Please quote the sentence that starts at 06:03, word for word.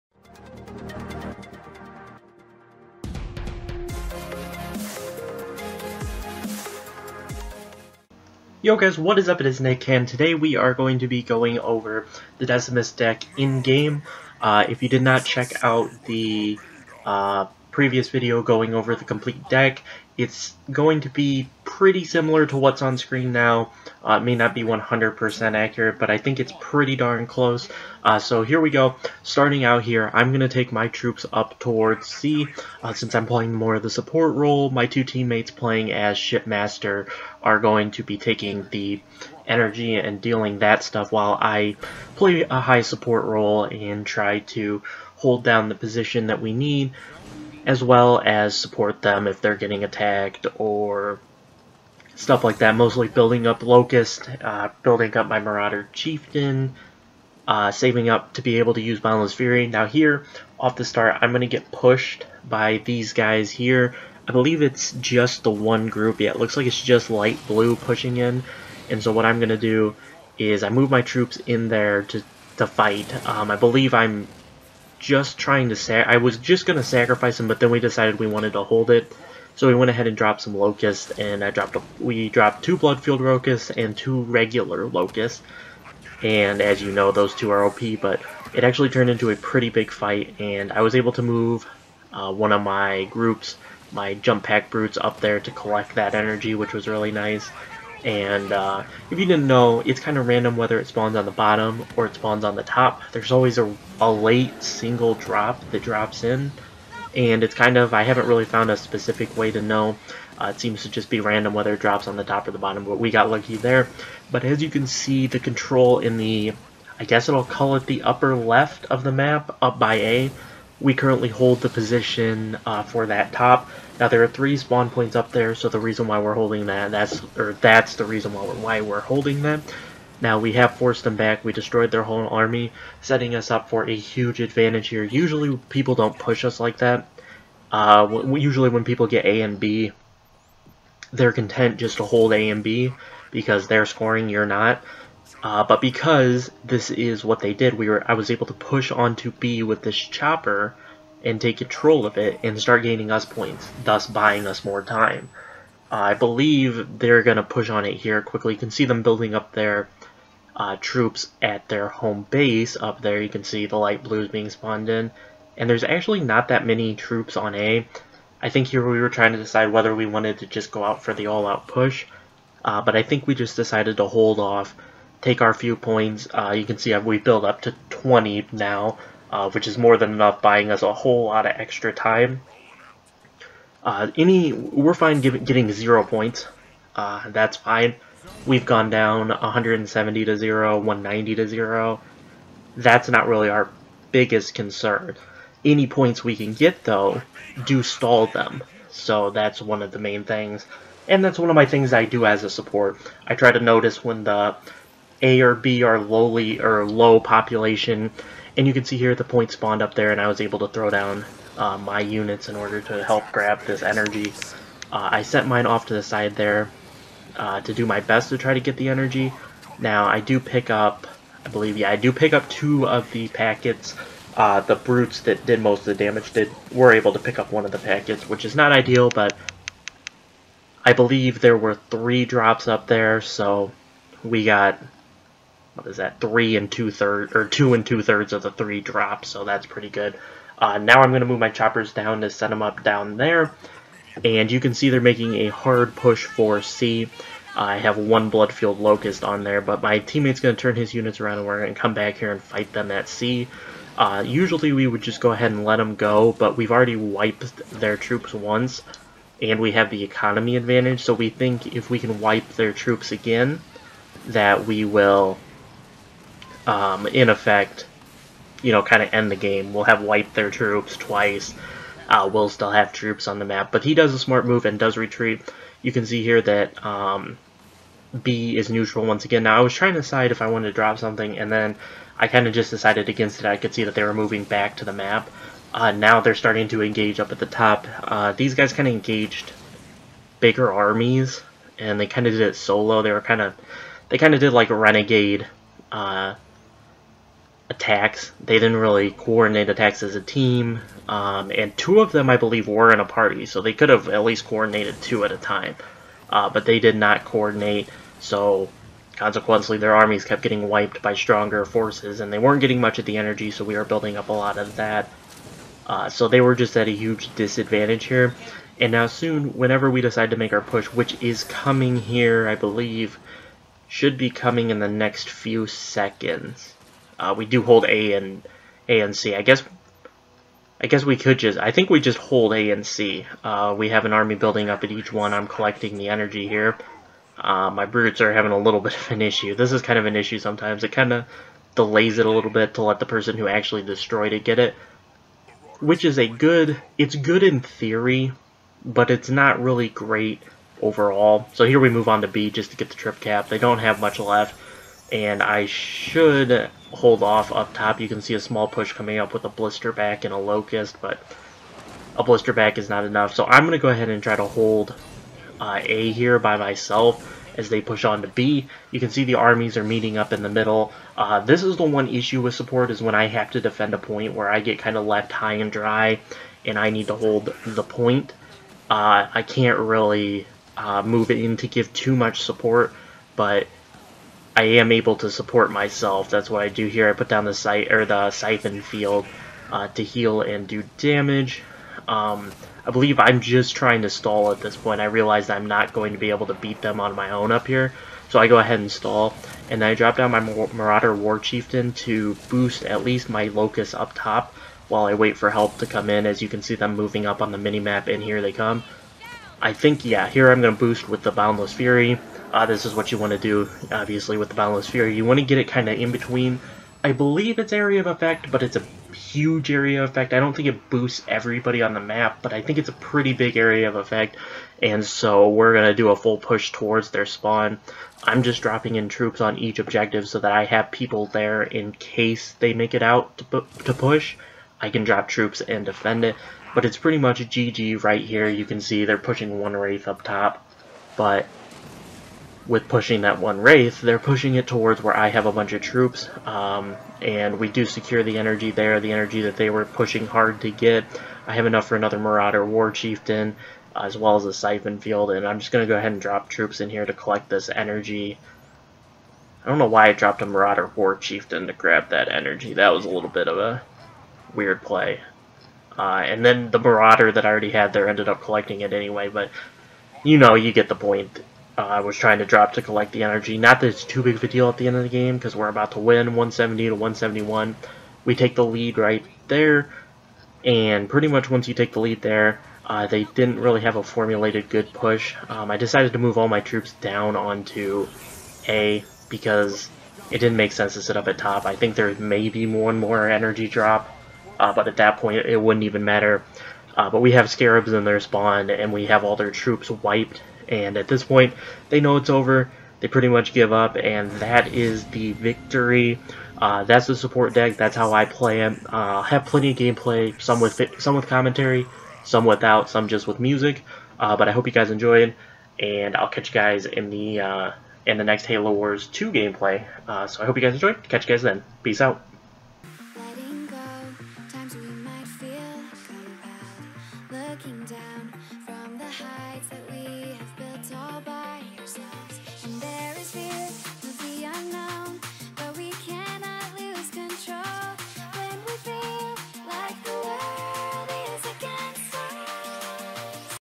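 So I'm going to go ahead and try to hold uh, A here by myself as they push on to B.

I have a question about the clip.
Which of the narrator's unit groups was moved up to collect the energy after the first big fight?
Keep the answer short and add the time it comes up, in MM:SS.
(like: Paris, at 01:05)
Jump Pack Brutes, at 01:34.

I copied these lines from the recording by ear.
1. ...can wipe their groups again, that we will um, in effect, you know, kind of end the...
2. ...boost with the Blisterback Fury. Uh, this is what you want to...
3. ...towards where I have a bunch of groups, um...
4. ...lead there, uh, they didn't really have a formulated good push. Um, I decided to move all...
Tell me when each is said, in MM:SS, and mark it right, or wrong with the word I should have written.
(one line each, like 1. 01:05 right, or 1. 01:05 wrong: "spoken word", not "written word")
1. 04:21 wrong: "troops", not "groups"
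2. 06:50 wrong: "Boundless", not "Blisterback"
3. 07:24 wrong: "troops", not "groups"
4. 08:02 right.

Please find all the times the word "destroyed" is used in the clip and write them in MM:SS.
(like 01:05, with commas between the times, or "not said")
02:11, 05:43.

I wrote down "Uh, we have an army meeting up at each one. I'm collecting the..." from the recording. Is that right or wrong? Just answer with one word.
wrong.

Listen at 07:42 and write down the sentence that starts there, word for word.
That was a little bit of a weird play.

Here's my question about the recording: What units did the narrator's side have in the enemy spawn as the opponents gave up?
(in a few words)
scarabs.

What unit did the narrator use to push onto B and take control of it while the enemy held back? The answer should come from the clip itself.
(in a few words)
chopper.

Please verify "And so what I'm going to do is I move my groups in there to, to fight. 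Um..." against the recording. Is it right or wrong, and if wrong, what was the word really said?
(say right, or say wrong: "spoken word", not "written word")
wrong: "troops", not "groups".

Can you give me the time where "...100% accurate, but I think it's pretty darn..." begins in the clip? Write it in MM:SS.
00:24.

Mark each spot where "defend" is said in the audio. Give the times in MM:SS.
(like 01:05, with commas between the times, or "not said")
06:13, 07:15.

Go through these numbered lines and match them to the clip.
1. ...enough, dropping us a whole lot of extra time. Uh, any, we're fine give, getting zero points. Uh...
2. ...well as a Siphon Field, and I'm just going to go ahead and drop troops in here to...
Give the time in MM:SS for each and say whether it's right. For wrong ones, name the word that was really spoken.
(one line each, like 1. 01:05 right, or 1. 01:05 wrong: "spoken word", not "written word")
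1. 03:00 wrong: "buying", not "dropping"
2. 07:34 right.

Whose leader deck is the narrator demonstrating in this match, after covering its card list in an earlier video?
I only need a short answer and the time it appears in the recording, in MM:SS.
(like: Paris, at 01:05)
Decimus, at 00:12.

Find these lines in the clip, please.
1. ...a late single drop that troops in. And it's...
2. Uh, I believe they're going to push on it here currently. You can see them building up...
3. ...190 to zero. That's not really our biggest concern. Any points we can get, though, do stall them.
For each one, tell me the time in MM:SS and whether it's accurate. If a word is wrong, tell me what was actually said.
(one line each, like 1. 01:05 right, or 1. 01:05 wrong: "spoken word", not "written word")
1. 01:43 wrong: "drops", not "troops"
2. 02:35 wrong: "quickly", not "currently"
3. 03:10 right.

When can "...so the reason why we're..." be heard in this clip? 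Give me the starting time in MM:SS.
02:05.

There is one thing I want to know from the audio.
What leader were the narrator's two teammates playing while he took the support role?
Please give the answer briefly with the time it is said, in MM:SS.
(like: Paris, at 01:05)
Shipmaster, at 00:36.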